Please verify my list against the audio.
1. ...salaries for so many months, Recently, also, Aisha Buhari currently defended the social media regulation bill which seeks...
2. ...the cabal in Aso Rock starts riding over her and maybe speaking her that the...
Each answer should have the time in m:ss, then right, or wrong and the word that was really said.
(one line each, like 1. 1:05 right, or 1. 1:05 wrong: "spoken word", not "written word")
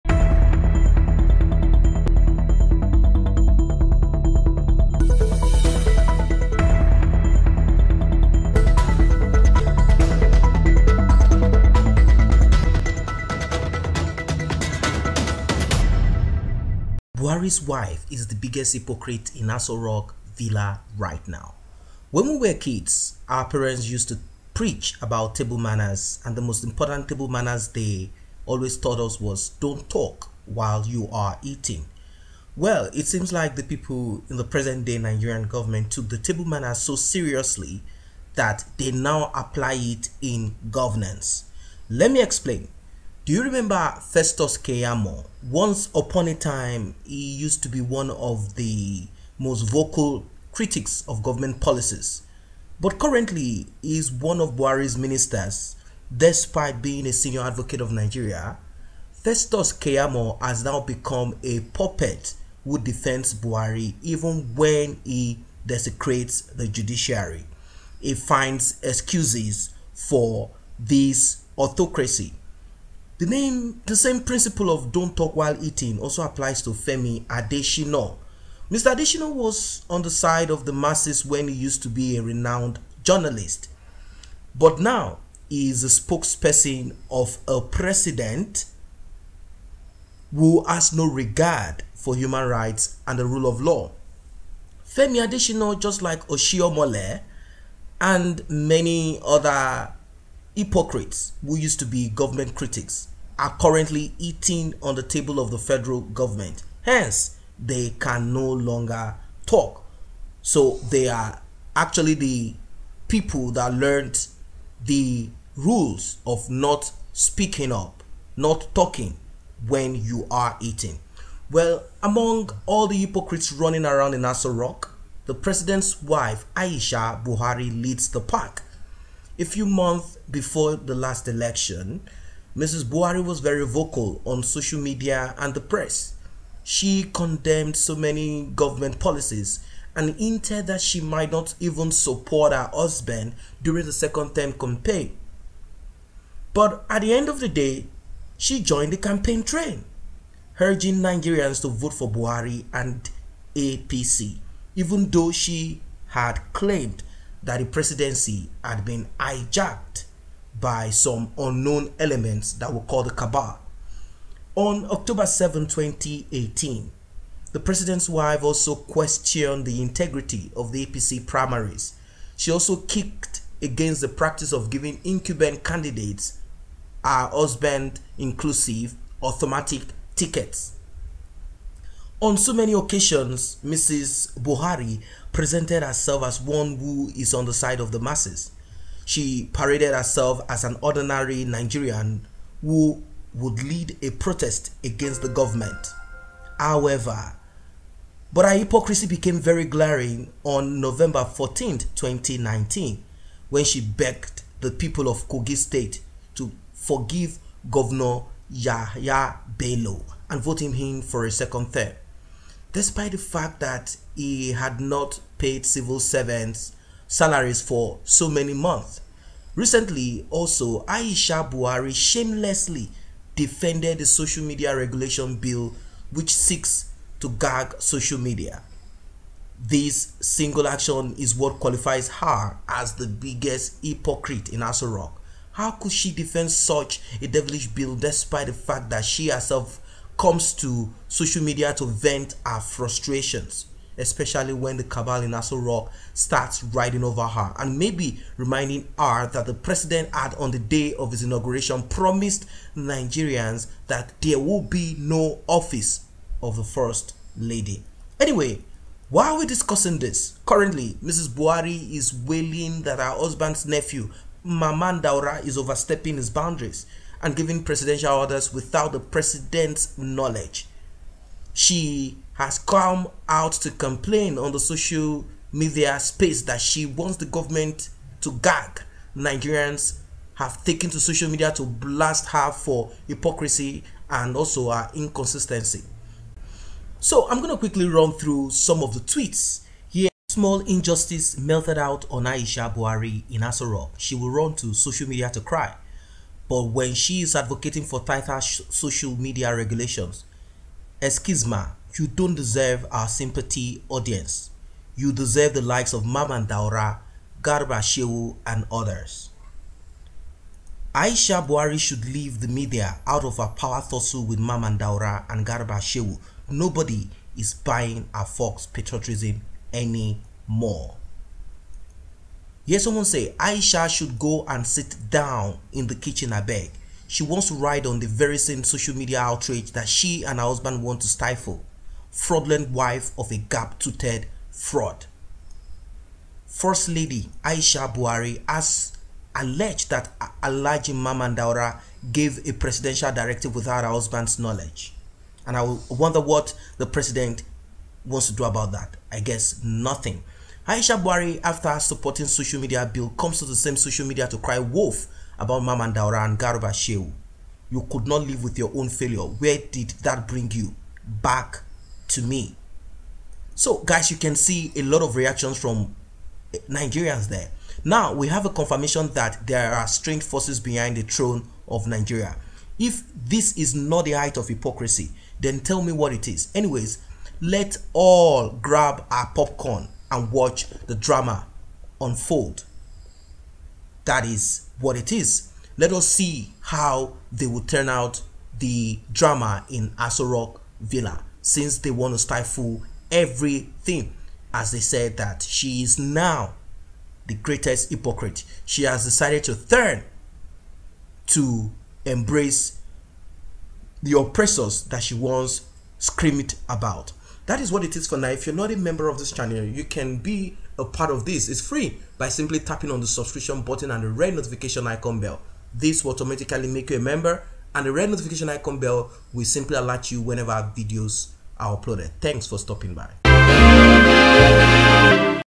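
1. 3:37 wrong: "shamelessly", not "currently"
2. 4:04 wrong: "reminding", not "speaking".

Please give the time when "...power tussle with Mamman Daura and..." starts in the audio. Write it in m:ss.
5:13.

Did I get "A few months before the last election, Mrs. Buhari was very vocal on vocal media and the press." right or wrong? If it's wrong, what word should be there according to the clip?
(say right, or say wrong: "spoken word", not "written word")
wrong: "social", not "vocal".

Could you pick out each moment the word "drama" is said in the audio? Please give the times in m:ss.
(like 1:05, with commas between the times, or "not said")
6:20, 6:29.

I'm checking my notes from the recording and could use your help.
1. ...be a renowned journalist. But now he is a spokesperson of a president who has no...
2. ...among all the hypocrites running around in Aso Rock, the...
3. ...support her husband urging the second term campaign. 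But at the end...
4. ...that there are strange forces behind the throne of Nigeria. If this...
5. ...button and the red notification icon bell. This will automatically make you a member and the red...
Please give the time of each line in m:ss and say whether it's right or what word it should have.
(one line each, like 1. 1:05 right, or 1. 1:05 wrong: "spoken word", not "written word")
1. 1:21 right
2. 2:02 right
3. 2:21 wrong: "during", not "urging"
4. 6:09 right
5. 6:53 right.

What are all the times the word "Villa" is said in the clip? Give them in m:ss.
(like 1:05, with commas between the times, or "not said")
0:20, 6:30.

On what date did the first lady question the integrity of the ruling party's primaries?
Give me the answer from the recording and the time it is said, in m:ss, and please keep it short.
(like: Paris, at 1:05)
October 7, 2018, at 2:44.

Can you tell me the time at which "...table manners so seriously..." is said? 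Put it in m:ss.
0:36.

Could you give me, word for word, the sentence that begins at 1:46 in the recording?
Hence, they can no longer talk.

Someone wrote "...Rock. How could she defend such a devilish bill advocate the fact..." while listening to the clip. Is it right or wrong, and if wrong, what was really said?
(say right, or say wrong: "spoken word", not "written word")
wrong: "despite", not "advocate".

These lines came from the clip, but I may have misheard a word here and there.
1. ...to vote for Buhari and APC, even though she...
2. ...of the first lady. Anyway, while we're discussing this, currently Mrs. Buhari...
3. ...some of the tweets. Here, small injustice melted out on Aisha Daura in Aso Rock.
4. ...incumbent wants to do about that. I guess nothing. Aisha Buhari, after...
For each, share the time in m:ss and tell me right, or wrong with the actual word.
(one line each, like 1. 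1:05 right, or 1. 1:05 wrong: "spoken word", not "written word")
1. 2:31 right
2. 4:16 right
3. 4:48 wrong: "Buhari", not "Daura"
4. 5:46 wrong: "president", not "incumbent".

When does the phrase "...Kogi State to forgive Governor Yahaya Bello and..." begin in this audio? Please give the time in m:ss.
3:25.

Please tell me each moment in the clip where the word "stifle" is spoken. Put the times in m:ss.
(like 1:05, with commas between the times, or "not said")
5:31, 6:32.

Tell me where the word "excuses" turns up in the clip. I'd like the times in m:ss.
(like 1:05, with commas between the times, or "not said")
1:08, 5:01.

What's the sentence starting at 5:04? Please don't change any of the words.
You deserve the likes of Mamman Daura, Garba Shehu and others.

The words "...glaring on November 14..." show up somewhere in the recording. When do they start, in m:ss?
3:19.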